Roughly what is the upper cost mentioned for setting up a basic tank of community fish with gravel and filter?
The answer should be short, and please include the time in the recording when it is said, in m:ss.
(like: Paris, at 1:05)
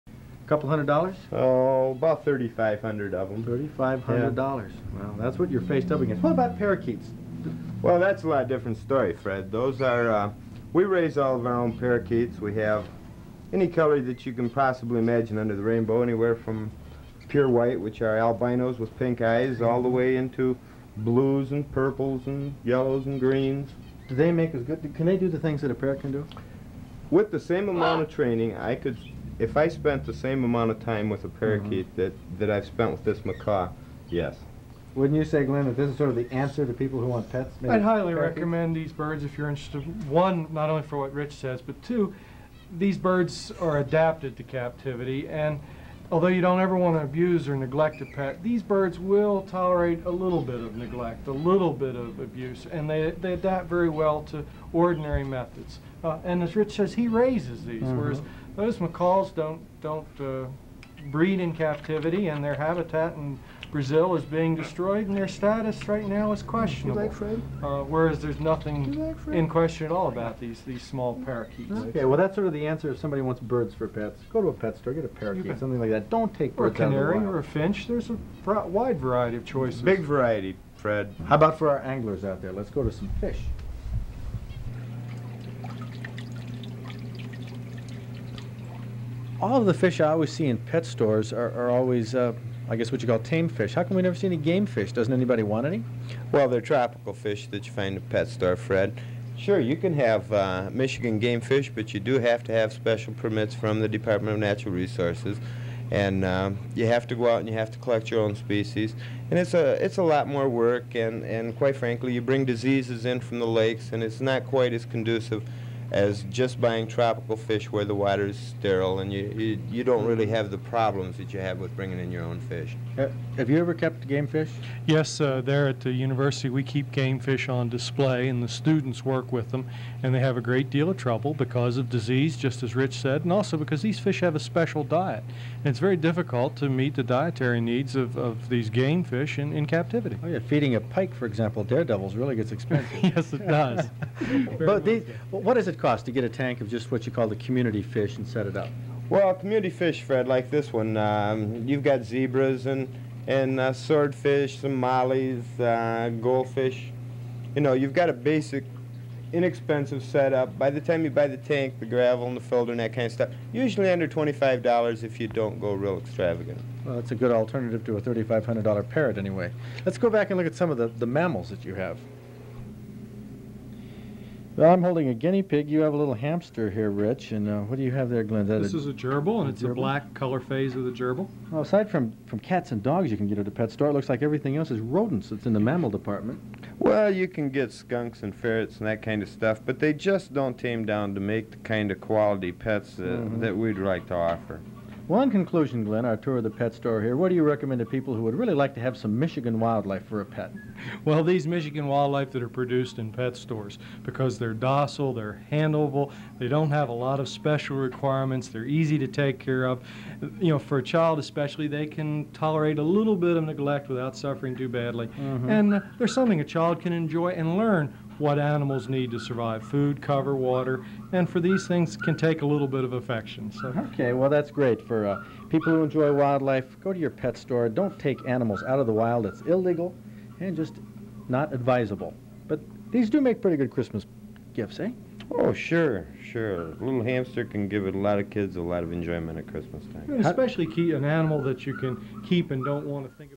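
$25, at 2:44.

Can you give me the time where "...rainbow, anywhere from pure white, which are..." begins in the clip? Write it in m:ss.
0:15.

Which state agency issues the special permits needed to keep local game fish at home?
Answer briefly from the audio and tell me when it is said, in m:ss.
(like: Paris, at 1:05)
Department of Natural Resources, at 1:43.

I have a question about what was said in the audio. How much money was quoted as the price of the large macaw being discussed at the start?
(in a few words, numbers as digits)
$3,500.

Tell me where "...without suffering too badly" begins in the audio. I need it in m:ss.
3:33.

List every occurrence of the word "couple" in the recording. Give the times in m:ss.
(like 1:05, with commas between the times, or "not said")
0:00.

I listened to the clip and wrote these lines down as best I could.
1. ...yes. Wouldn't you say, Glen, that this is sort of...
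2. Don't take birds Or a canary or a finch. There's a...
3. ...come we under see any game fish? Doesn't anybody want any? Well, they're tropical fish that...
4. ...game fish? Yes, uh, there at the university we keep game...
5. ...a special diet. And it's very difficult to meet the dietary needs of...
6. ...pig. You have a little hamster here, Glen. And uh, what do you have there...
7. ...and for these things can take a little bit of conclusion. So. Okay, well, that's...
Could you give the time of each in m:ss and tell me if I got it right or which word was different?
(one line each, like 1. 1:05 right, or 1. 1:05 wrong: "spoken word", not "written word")
1. 0:34 right
2. 1:16 right
3. 1:33 wrong: "never", not "under"
4. 2:04 right
5. 2:14 right
6. 2:55 wrong: "Rich", not "Glen"
7. 3:41 wrong: "affection", not "conclusion".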